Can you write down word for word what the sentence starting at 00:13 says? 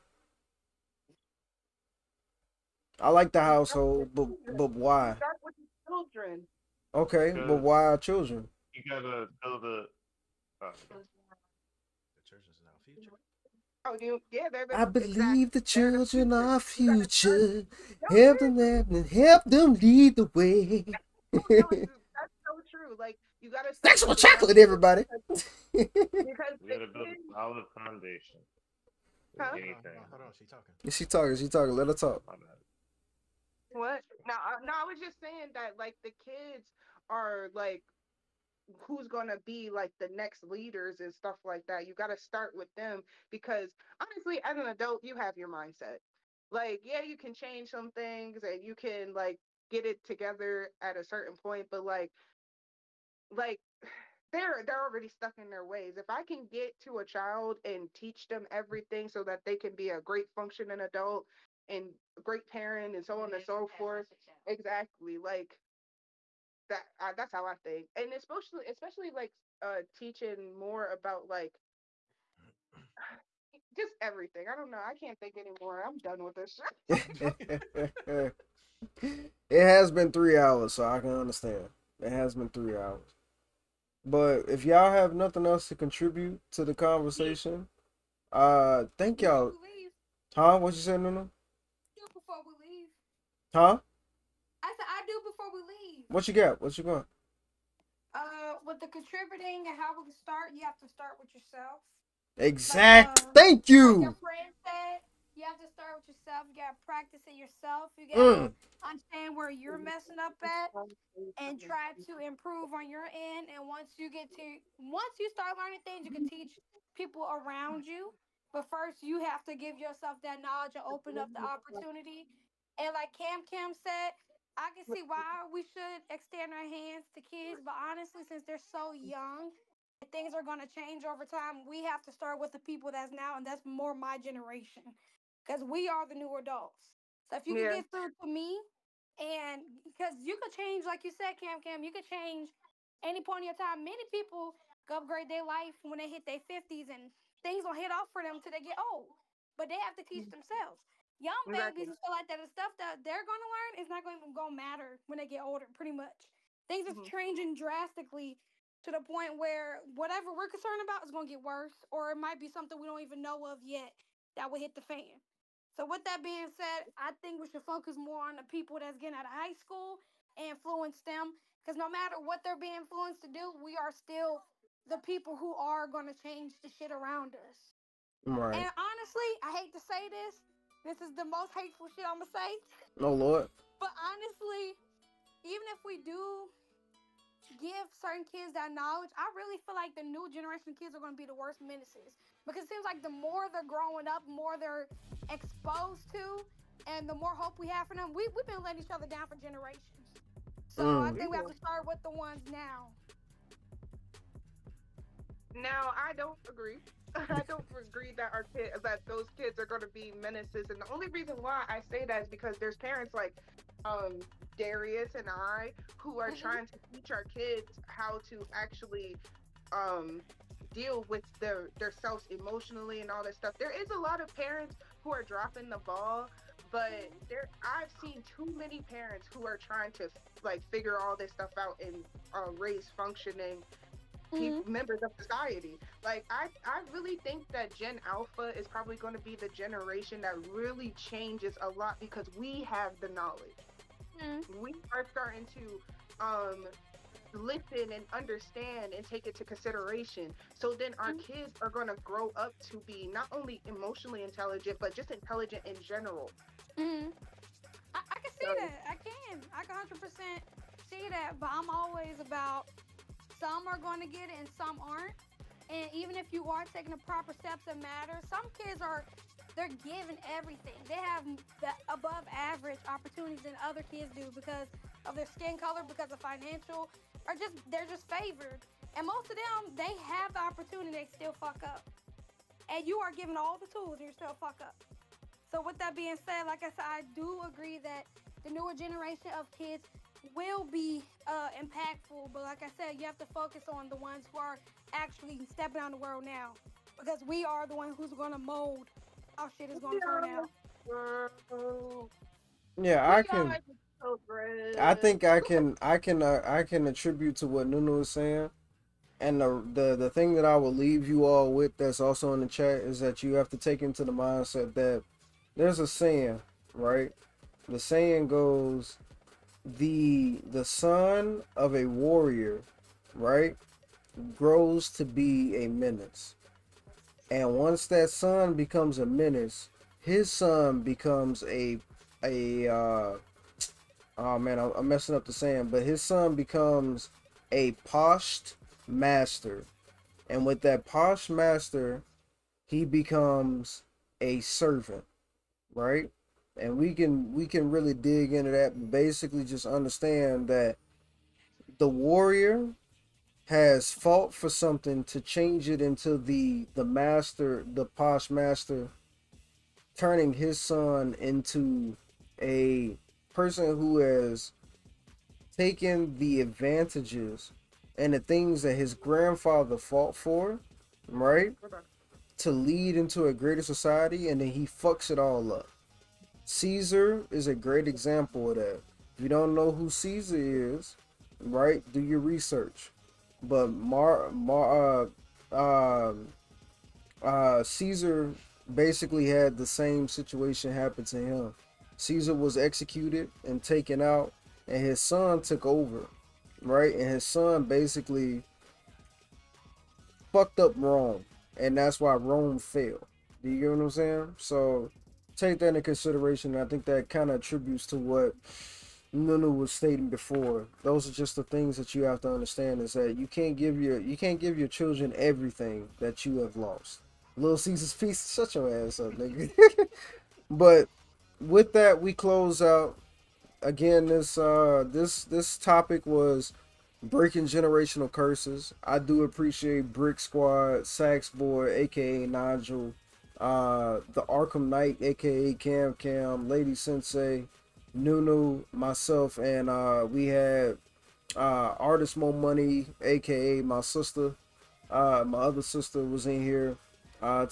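Oh, you, yeah, they're, I believe exactly.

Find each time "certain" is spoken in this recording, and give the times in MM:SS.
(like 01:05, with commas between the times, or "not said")
00:51, 03:07.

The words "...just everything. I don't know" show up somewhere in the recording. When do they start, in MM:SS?
01:13.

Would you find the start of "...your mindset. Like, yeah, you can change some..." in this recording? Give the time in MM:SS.
00:45.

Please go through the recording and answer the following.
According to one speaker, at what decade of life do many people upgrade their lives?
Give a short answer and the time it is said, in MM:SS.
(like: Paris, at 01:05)
50s, at 02:26.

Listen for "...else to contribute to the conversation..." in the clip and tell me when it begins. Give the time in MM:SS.
01:25.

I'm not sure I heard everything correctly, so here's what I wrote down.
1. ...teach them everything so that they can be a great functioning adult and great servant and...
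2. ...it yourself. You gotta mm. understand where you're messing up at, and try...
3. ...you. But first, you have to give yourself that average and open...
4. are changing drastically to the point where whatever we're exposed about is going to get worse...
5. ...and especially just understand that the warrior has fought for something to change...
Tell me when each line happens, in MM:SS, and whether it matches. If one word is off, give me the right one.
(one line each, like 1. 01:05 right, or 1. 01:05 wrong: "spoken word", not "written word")
1. 00:57 wrong: "parent", not "servant"
2. 01:47 right
3. 01:57 wrong: "knowledge", not "average"
4. 02:36 wrong: "concerned", not "exposed"
5. 05:48 wrong: "basically", not "especially".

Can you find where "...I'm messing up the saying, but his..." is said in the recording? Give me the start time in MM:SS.
05:34.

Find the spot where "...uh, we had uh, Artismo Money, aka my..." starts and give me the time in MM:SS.
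07:19.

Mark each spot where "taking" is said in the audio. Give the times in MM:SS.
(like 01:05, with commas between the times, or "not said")
04:26.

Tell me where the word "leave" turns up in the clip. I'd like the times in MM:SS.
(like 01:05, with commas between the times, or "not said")
01:31, 05:10.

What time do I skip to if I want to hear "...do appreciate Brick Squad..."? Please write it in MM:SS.
07:08.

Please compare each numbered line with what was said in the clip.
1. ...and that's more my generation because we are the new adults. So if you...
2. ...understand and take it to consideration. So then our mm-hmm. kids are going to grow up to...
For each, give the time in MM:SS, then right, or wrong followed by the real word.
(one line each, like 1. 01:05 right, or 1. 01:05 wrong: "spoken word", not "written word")
1. 02:13 right
2. 04:08 right.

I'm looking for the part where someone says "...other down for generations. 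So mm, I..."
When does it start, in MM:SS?
03:18.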